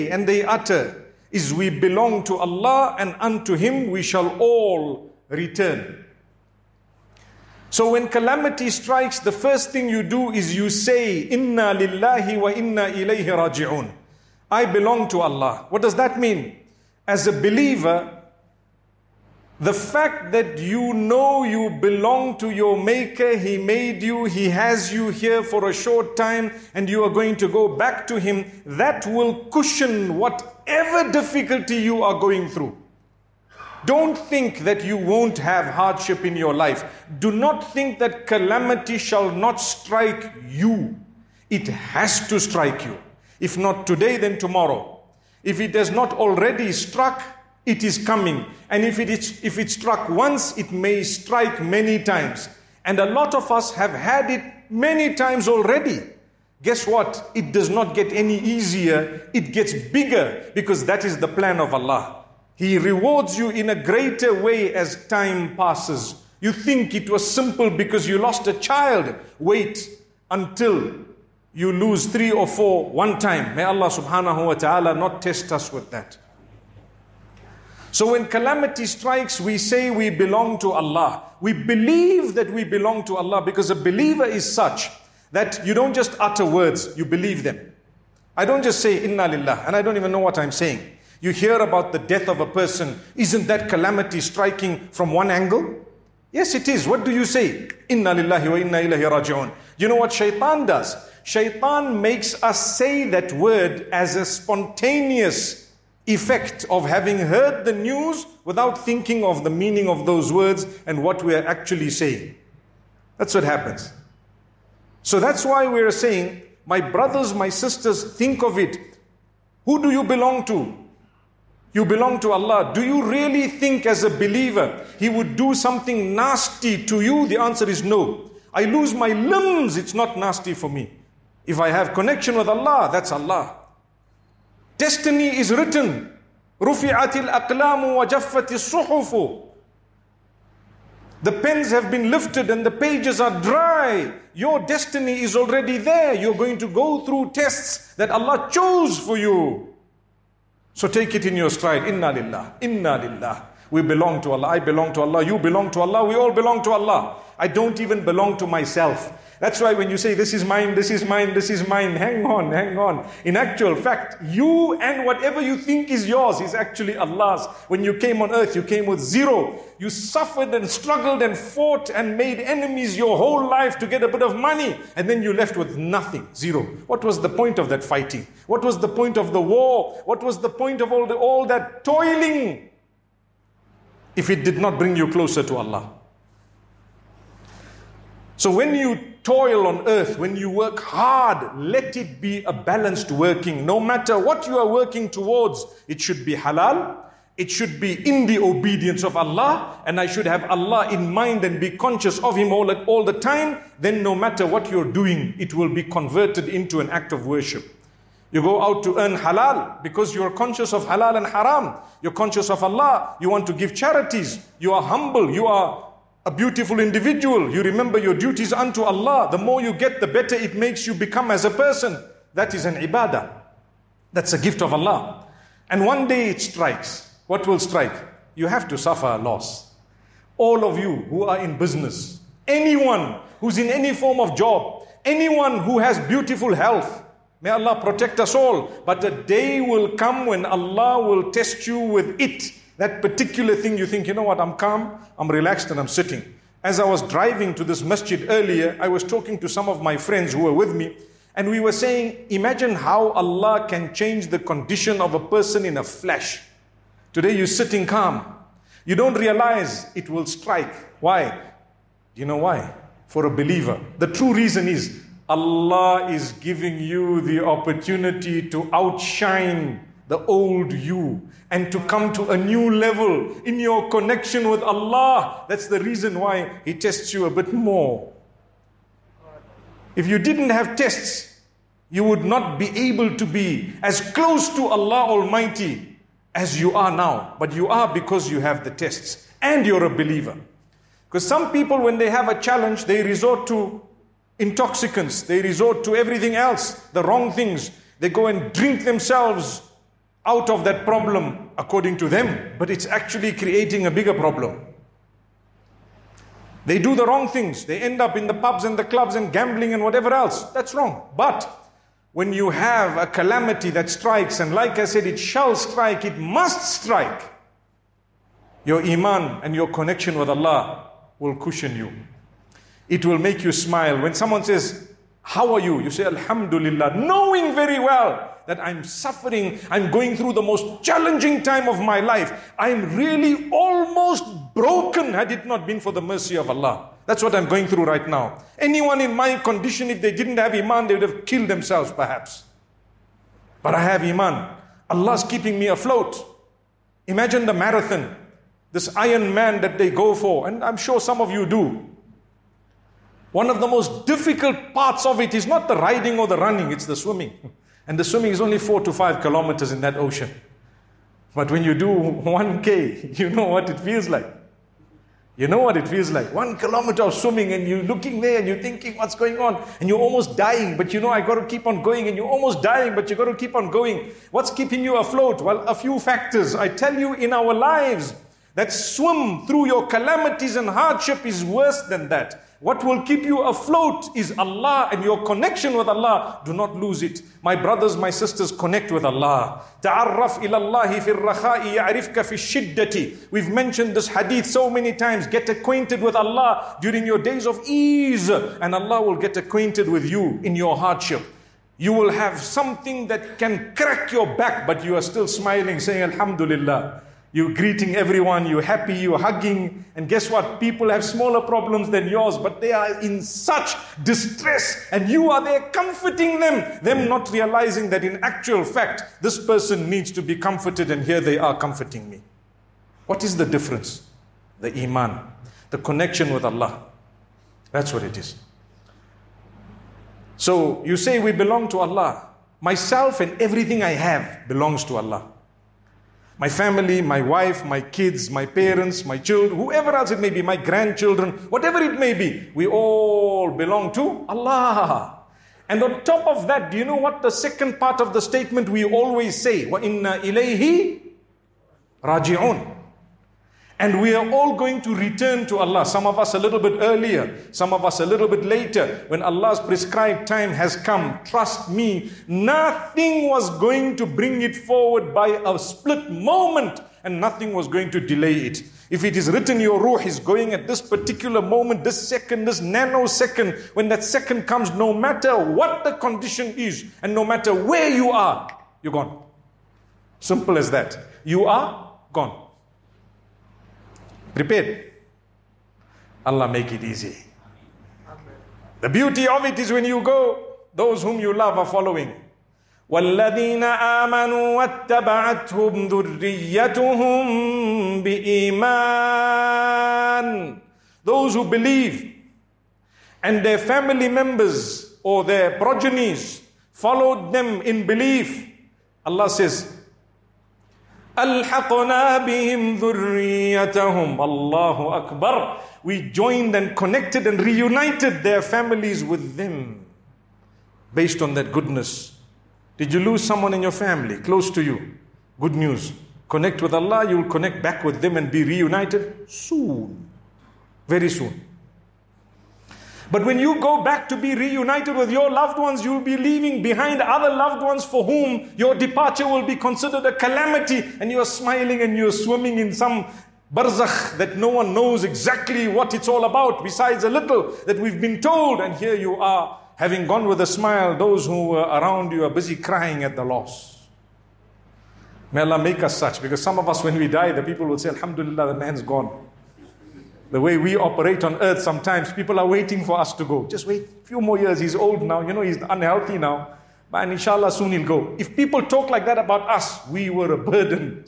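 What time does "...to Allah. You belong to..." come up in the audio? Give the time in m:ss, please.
2:34.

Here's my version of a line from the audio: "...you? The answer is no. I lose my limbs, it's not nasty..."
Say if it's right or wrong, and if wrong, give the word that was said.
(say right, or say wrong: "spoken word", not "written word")
right.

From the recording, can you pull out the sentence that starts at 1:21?
We believe that we belong to Allah because a believer is such that you don't just utter words, you believe them.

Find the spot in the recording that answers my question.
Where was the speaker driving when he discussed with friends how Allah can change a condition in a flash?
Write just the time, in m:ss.
4:07.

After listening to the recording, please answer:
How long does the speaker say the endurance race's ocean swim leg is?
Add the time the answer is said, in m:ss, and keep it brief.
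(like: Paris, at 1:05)
4 to 5 kilometers, at 5:58.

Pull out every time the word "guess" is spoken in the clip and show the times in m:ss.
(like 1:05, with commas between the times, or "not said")
0:56, 6:50.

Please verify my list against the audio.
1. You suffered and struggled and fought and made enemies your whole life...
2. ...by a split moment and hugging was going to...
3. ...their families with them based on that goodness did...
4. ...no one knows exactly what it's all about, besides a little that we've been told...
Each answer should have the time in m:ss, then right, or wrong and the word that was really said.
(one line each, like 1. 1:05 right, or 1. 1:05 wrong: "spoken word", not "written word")
1. 2:49 right
2. 7:45 wrong: "nothing", not "hugging"
3. 8:38 right
4. 9:04 right.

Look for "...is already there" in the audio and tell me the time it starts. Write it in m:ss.
2:25.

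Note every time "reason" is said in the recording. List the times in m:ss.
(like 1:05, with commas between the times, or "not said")
4:24, 4:35.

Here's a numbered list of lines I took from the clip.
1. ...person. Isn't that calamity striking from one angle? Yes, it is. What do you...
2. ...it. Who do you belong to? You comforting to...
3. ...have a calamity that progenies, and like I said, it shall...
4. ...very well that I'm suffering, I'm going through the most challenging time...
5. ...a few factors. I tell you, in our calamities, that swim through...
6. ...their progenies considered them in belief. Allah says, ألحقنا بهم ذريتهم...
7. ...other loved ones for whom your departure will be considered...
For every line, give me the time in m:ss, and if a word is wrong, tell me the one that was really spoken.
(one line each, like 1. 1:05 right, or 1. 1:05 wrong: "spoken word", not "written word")
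1. 1:32 right
2. 1:58 wrong: "belong", not "comforting"
3. 5:12 wrong: "strikes", not "progenies"
4. 5:27 right
5. 6:15 wrong: "lives", not "calamities"
6. 8:25 wrong: "followed", not "considered"
7. 8:57 right.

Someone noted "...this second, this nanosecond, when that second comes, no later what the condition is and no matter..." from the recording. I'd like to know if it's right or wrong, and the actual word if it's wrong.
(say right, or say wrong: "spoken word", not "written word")
wrong: "matter", not "later".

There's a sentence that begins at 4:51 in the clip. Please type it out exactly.
Because some people, when they have a challenge, they resort to intoxicants, they resort to everything else, the wrong things.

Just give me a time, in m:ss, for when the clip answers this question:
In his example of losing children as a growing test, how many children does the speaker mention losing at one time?
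1:12.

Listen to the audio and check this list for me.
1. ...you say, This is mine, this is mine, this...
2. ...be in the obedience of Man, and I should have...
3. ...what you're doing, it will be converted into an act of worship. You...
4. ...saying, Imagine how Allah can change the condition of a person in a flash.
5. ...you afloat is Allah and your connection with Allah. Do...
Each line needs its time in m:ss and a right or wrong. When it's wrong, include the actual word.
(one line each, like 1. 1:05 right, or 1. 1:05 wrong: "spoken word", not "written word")
1. 2:39 right
2. 3:17 wrong: "Allah", not "Man"
3. 3:24 right
4. 4:11 right
5. 6:23 right.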